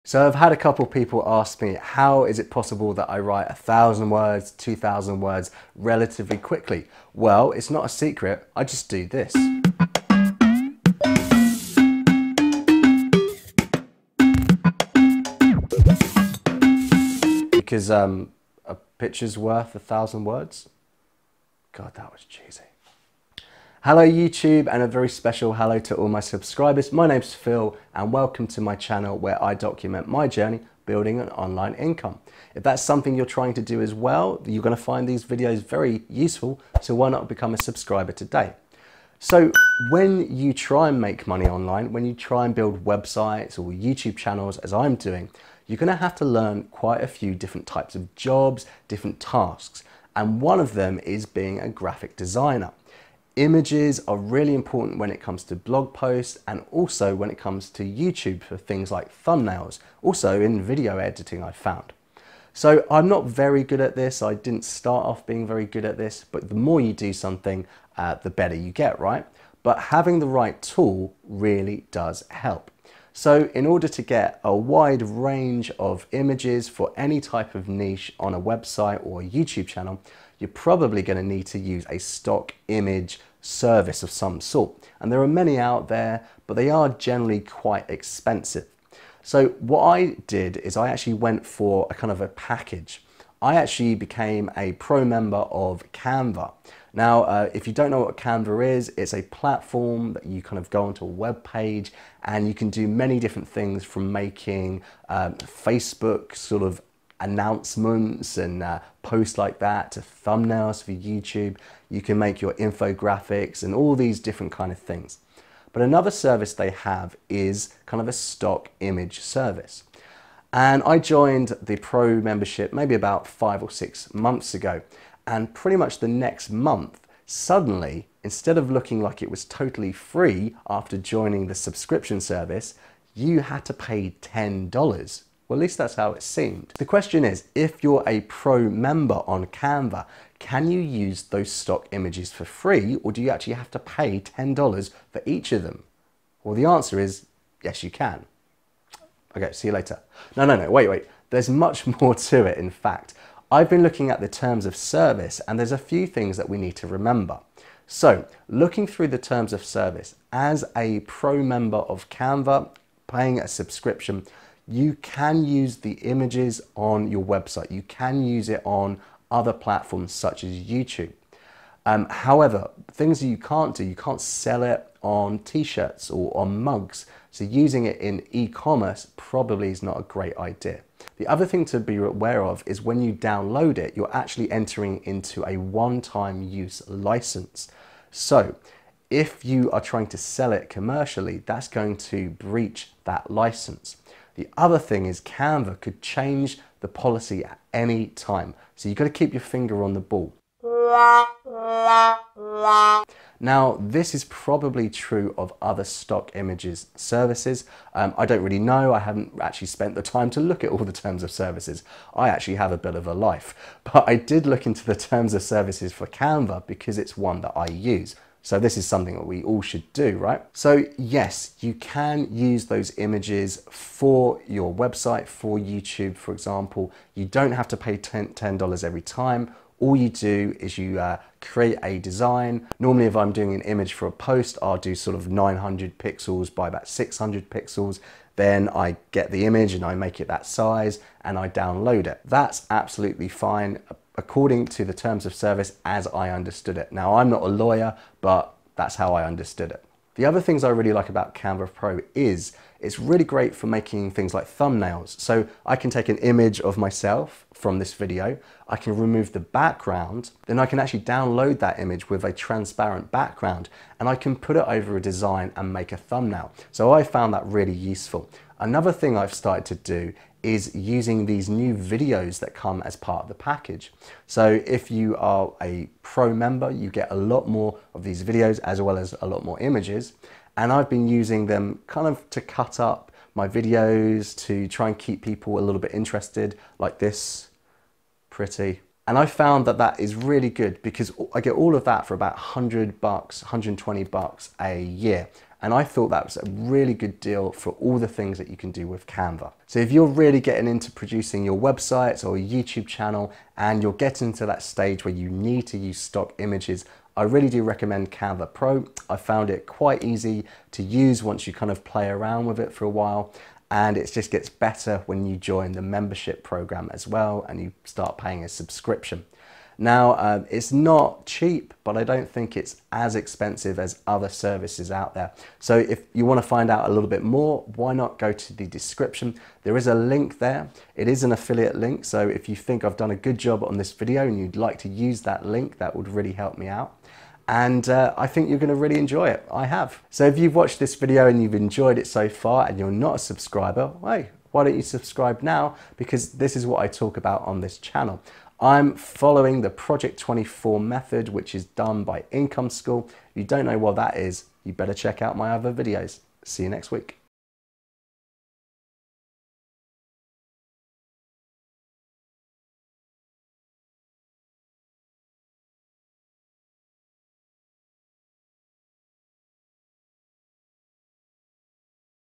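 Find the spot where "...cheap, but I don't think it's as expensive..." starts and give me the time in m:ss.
5:21.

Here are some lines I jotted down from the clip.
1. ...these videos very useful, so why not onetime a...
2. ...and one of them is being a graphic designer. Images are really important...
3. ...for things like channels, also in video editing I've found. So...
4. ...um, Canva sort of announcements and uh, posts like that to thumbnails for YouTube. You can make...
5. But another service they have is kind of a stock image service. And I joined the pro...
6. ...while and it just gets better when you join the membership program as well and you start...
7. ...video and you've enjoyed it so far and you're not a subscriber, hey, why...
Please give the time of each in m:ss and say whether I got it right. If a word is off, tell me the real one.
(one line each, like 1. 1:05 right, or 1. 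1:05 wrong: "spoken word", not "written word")
1. 0:35 wrong: "become", not "onetime"
2. 0:50 right
3. 0:58 wrong: "thumbnails", not "channels"
4. 1:45 wrong: "Facebook", not "Canva"
5. 1:55 right
6. 5:12 right
7. 5:40 right.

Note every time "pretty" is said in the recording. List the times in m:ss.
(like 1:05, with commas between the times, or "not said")
2:05, 4:48.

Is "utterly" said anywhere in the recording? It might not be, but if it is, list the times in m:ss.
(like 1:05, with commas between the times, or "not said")
not said.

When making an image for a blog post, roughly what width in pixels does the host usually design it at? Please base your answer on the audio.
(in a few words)
900.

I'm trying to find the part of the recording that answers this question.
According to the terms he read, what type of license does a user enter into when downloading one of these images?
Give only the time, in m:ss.
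3:05.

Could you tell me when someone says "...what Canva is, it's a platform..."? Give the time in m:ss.
1:38.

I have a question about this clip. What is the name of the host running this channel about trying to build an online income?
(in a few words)
Phil.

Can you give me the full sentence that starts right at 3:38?
So this is something that we all should do, right?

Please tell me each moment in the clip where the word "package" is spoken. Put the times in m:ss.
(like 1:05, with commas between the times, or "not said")
1:32, 4:33.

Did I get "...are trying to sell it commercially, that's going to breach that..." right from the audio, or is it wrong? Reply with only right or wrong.
right.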